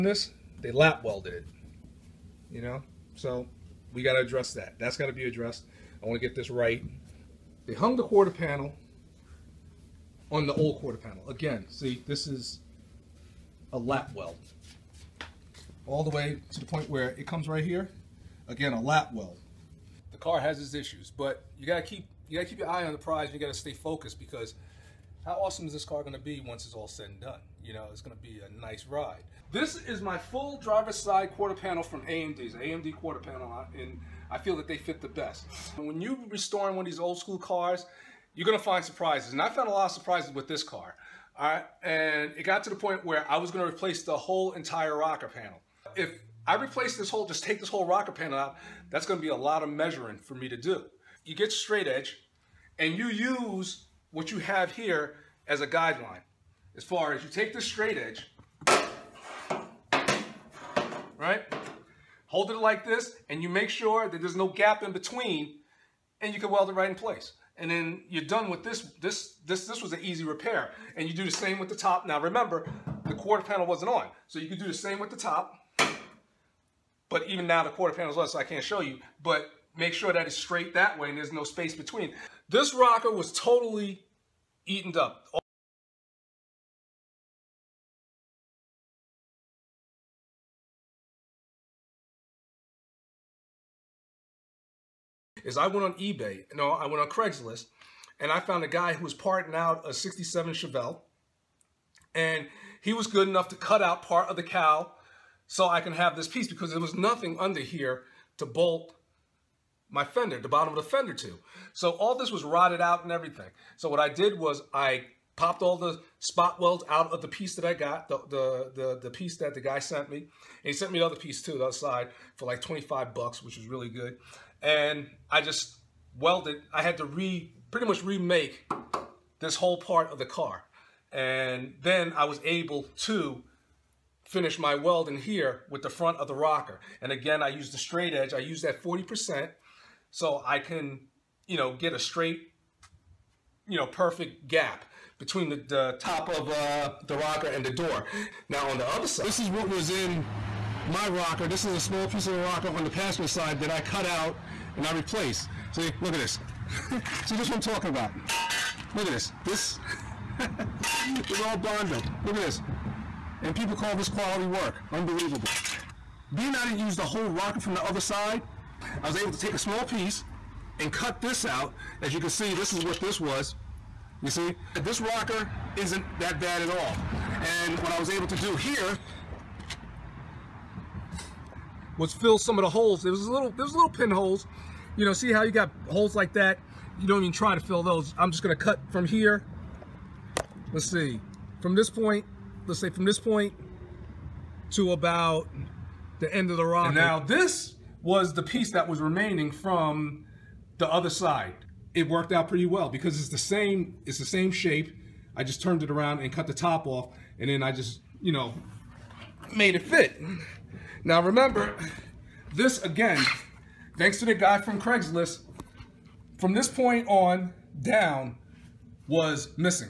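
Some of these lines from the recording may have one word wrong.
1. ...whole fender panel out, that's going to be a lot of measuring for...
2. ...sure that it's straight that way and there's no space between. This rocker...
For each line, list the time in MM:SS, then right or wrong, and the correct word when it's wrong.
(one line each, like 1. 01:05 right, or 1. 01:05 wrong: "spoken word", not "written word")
1. 00:47 wrong: "rocker", not "fender"
2. 01:19 right.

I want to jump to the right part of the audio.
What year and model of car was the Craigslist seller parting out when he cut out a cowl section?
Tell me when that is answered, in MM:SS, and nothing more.
01:39.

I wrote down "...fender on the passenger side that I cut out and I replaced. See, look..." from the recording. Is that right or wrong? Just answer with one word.
wrong.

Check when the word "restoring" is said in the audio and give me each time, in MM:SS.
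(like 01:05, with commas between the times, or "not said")
00:36.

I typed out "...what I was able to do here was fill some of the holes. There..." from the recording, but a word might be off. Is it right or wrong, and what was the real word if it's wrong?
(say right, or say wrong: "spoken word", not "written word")
right.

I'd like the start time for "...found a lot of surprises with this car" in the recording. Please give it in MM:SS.
00:39.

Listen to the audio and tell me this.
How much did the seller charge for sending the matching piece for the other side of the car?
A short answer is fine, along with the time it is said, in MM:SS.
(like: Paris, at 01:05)
$25, at 02:02.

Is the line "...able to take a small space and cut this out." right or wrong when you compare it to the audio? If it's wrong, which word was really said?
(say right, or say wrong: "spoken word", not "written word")
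wrong: "piece", not "space".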